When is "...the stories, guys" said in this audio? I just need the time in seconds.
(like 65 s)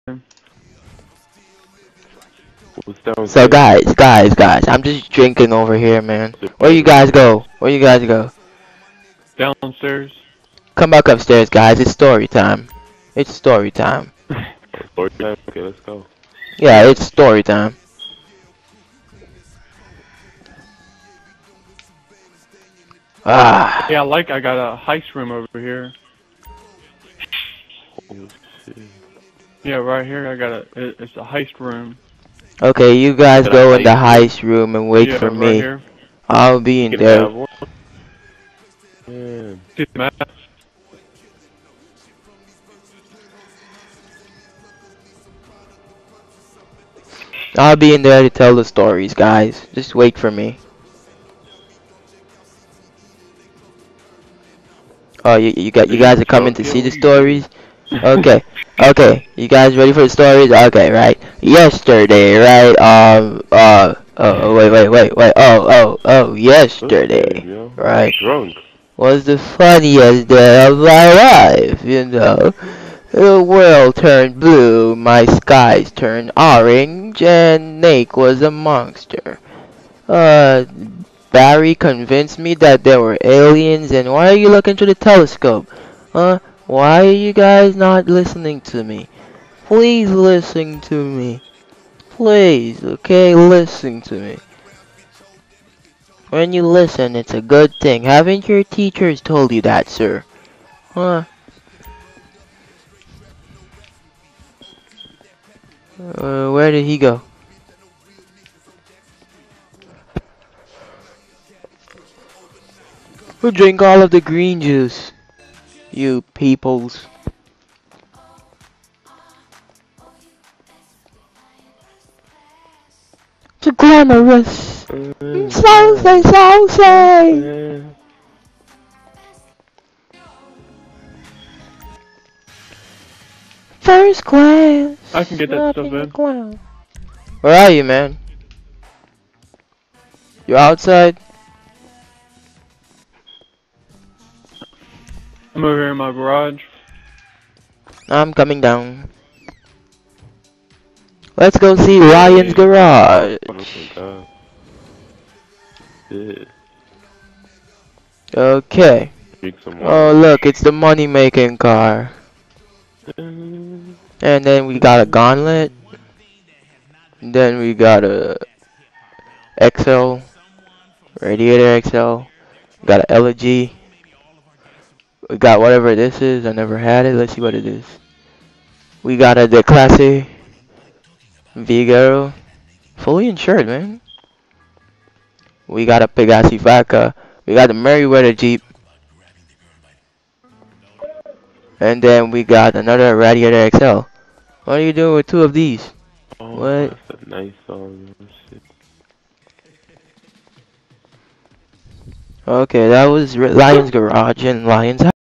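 48 s.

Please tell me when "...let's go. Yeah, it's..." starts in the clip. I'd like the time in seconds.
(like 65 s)
15 s.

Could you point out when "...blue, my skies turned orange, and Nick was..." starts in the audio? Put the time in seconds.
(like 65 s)
74 s.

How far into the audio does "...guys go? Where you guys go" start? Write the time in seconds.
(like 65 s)
6 s.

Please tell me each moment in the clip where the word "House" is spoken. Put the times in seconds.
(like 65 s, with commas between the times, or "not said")
205 s.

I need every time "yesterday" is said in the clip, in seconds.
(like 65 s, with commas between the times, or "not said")
61 s, 66 s.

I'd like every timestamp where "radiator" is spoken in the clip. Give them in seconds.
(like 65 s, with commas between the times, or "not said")
171 s, 193 s.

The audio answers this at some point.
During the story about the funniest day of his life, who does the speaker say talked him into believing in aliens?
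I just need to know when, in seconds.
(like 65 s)
81 s.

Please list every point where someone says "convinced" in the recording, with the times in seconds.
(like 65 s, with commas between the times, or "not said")
81 s.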